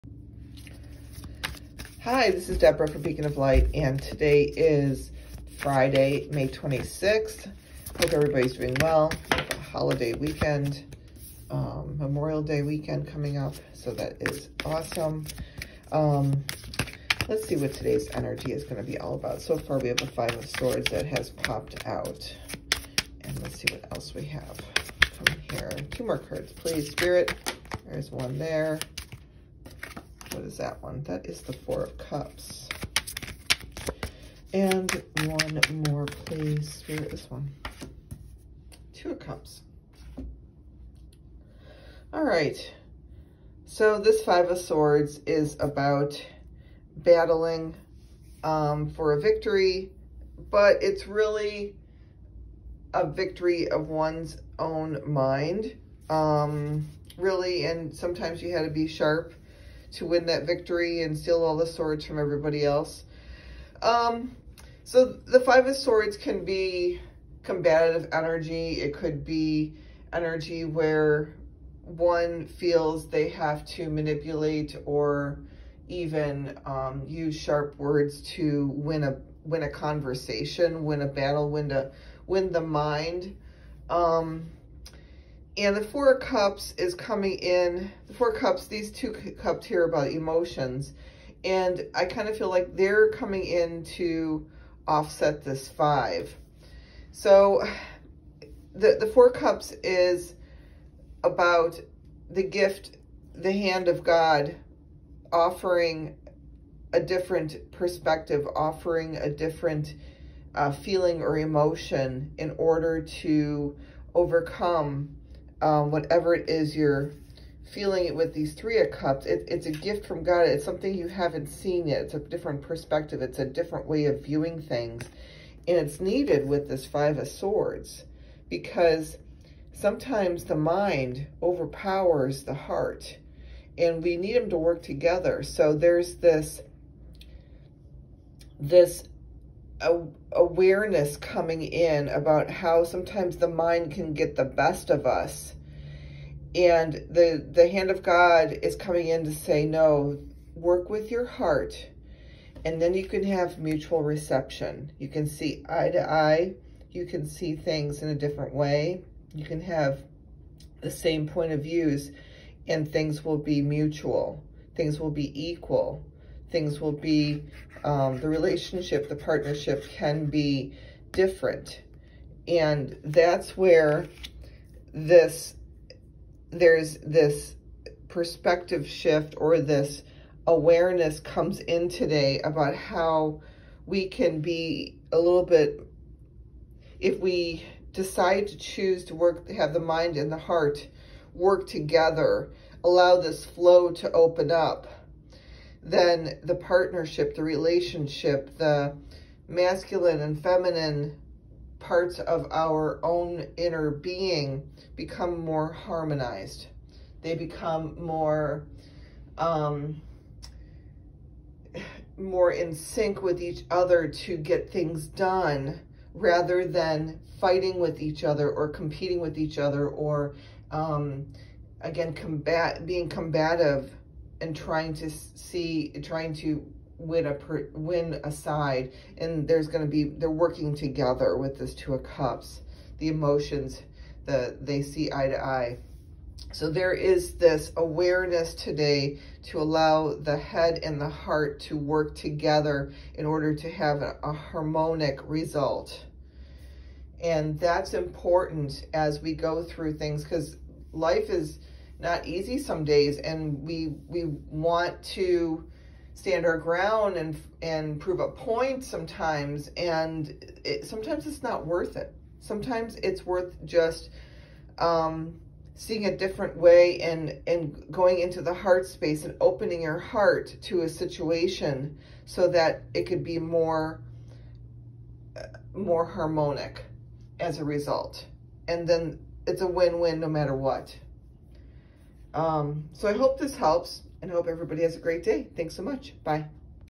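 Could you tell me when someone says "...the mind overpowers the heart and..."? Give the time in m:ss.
2:10.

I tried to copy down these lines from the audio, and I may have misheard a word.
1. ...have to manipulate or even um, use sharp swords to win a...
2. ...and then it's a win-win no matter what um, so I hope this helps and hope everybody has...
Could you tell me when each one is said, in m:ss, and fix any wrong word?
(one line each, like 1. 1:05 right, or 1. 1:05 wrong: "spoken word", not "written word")
1. 1:13 wrong: "words", not "swords"
2. 4:38 right.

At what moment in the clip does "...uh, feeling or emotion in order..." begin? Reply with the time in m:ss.
1:50.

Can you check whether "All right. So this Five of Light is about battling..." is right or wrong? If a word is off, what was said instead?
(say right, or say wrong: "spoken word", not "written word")
wrong: "Swords", not "Light".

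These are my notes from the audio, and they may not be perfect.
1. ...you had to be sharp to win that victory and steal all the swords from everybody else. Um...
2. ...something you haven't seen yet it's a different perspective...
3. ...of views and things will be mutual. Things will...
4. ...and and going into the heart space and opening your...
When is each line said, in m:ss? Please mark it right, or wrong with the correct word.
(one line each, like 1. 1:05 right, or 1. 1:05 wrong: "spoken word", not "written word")
1. 0:58 right
2. 2:00 right
3. 2:41 right
4. 4:27 right.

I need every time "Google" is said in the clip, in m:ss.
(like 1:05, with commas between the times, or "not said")
not said.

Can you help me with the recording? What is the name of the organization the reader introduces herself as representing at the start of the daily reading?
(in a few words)
Beacon of Light.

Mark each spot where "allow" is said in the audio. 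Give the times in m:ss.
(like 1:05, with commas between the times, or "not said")
3:12, 3:59.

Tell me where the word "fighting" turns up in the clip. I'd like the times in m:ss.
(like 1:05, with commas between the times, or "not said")
3:37.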